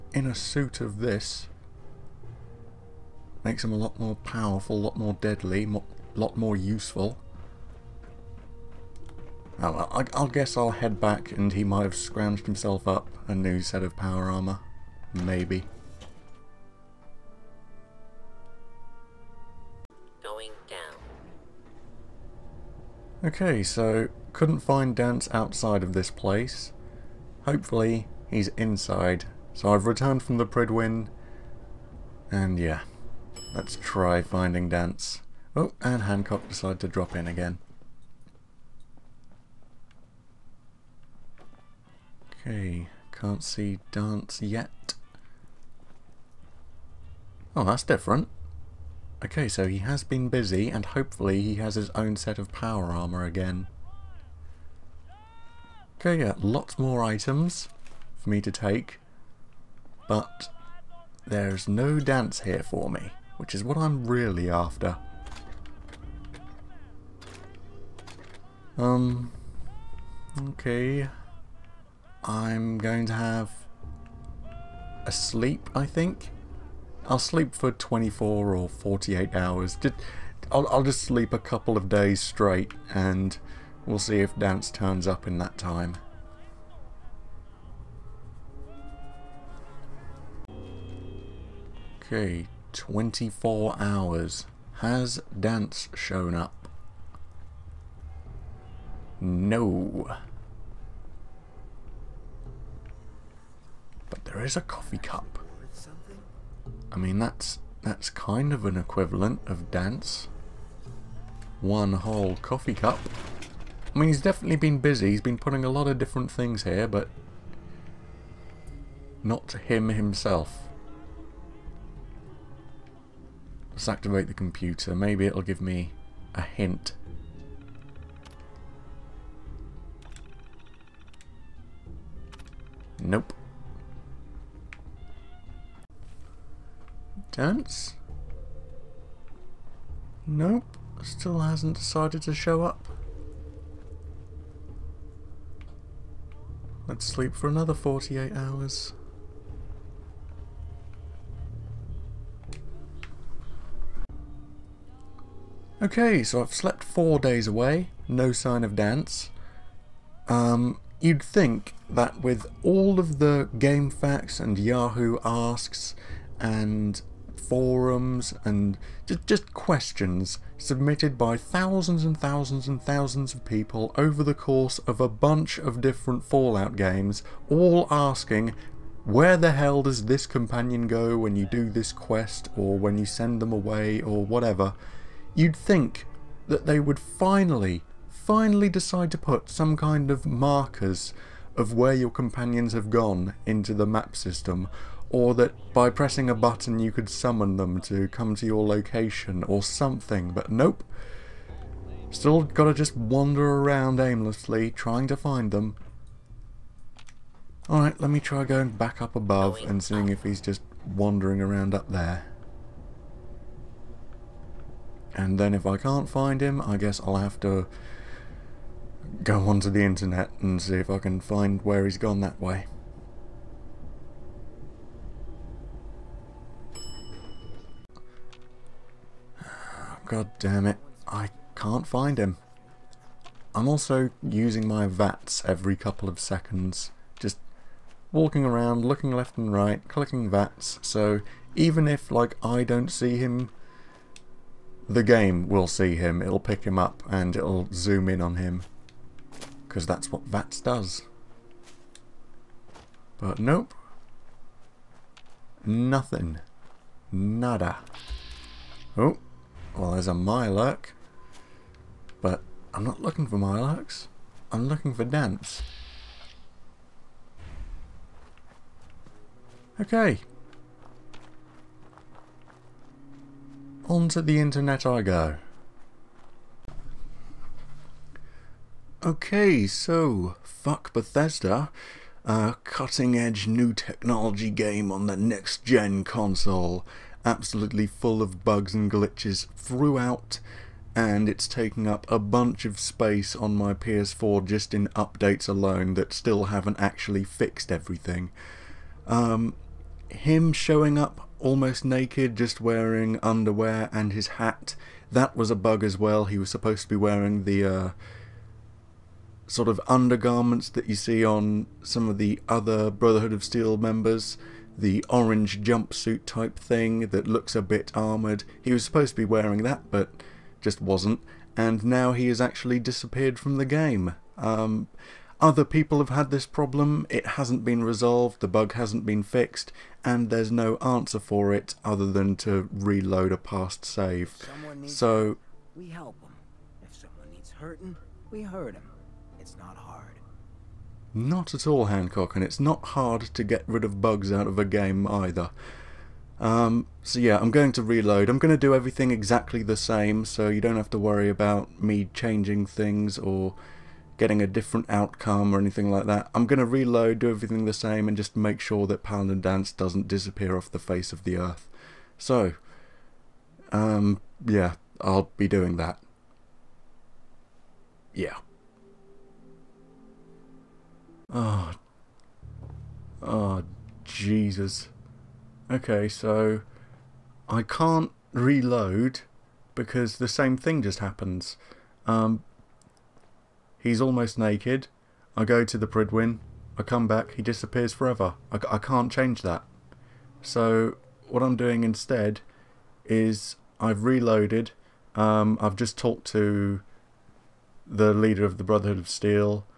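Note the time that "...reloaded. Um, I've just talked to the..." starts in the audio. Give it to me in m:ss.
6:34.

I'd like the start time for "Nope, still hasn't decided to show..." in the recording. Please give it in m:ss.
2:20.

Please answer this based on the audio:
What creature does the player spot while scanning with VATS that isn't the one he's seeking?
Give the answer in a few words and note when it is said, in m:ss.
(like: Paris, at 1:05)
Miloc, at 4:20.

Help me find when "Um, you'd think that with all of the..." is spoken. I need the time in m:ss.
2:40.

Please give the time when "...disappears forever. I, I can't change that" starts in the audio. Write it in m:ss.
6:27.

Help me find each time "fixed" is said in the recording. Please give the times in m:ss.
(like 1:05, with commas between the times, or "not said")
4:57, 5:29.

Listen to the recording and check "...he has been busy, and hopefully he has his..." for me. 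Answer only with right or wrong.
right.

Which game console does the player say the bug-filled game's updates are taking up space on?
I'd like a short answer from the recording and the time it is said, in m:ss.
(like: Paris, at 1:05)
PS4, at 4:53.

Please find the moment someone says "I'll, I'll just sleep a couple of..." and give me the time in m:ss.
1:20.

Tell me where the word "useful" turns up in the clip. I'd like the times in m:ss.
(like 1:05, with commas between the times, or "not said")
0:06.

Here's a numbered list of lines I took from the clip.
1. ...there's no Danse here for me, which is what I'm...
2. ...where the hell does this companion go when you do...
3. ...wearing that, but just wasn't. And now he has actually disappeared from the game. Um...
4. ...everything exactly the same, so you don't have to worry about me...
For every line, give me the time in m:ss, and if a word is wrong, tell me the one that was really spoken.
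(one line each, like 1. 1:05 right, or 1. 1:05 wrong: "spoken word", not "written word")
1. 1:01 right
2. 2:59 right
3. 5:19 right
4. 5:48 right.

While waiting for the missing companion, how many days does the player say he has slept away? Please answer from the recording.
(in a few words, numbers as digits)
4.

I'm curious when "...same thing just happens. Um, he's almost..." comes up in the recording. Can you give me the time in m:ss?
6:20.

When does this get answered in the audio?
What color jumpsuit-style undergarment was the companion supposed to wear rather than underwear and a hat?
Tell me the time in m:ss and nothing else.
5:15.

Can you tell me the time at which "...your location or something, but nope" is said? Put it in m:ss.
3:18.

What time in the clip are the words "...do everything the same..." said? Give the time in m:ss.
5:57.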